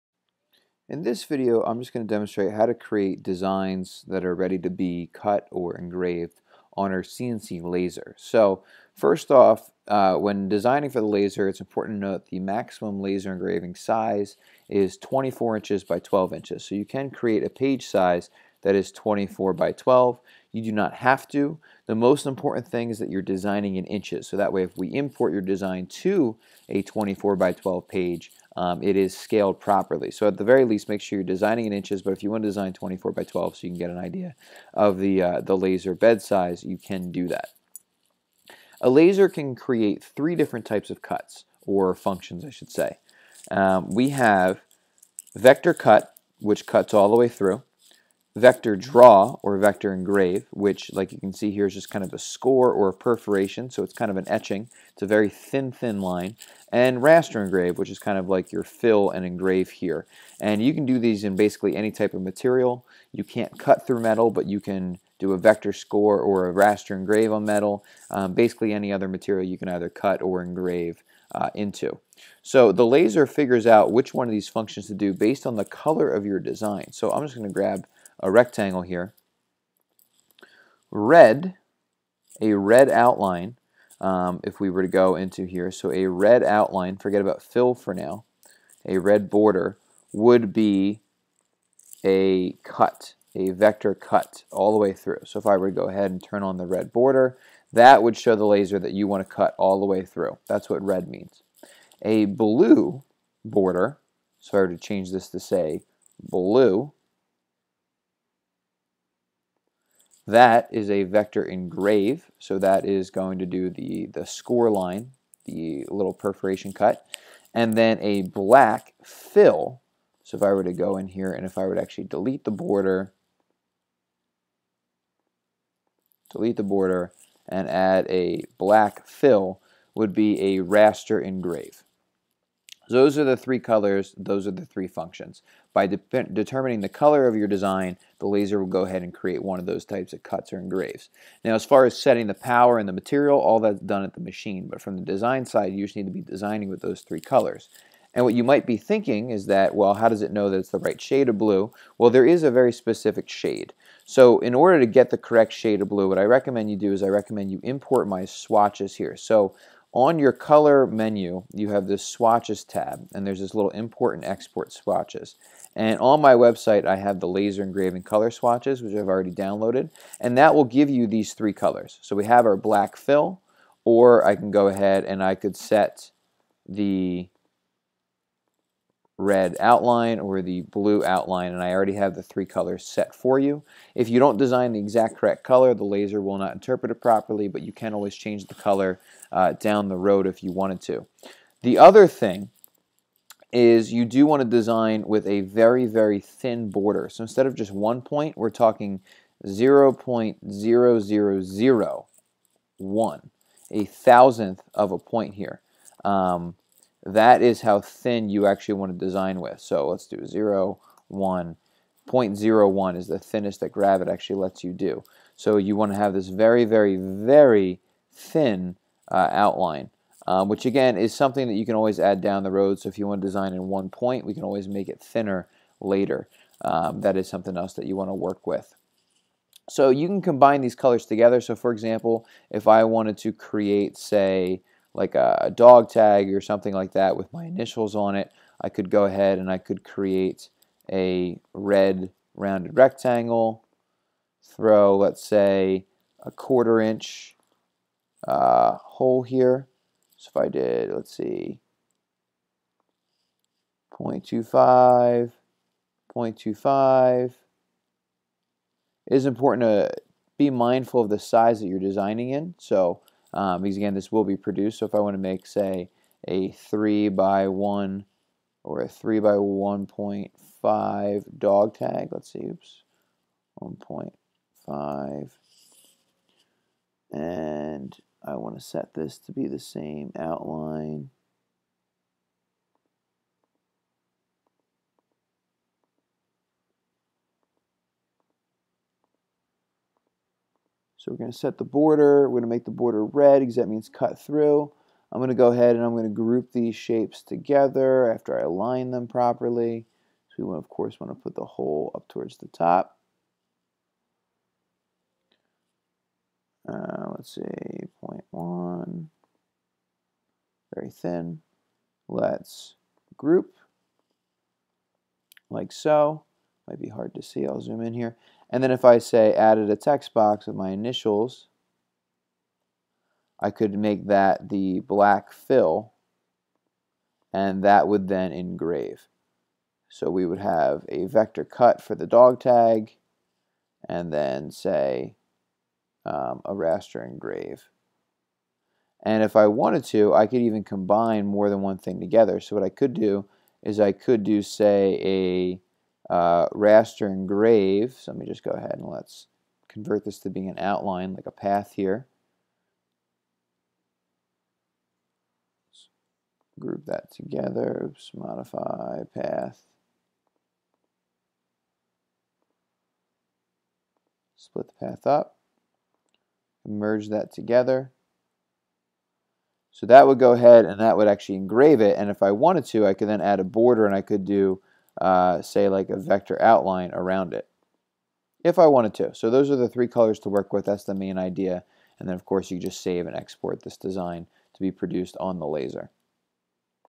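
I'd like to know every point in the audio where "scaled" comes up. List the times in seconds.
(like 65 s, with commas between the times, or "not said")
29 s.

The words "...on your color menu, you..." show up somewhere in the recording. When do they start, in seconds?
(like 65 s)
159 s.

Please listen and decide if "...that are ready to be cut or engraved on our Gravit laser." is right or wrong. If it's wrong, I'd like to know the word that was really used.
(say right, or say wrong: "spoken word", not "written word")
wrong: "CNC", not "Gravit".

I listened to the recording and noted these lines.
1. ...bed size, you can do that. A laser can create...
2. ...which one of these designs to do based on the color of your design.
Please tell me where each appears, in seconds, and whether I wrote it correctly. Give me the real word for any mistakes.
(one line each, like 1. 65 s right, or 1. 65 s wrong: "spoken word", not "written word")
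1. 35 s right
2. 73 s wrong: "functions", not "designs".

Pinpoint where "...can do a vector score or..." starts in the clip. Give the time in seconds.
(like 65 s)
64 s.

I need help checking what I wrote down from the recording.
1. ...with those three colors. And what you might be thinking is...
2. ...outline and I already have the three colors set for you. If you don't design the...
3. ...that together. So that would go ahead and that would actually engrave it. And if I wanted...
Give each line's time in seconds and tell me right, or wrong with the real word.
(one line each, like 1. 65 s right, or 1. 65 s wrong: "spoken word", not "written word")
1. 146 s right
2. 181 s right
3. 367 s right.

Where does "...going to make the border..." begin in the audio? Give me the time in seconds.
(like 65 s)
292 s.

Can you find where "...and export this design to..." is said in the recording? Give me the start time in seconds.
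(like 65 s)
383 s.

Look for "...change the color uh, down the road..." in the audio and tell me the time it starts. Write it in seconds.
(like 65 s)
188 s.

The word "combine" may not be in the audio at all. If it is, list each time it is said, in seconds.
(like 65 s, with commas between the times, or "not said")
230 s, 340 s.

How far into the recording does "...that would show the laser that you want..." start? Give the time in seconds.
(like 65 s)
97 s.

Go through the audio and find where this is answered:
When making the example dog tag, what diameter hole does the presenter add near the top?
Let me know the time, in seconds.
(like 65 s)
246 s.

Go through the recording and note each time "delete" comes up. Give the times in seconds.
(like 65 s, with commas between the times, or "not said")
122 s, 126 s.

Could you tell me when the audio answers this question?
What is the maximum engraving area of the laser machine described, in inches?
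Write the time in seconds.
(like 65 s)
14 s.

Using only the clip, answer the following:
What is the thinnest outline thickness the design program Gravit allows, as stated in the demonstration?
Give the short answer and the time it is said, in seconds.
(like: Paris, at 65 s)
0.01, at 212 s.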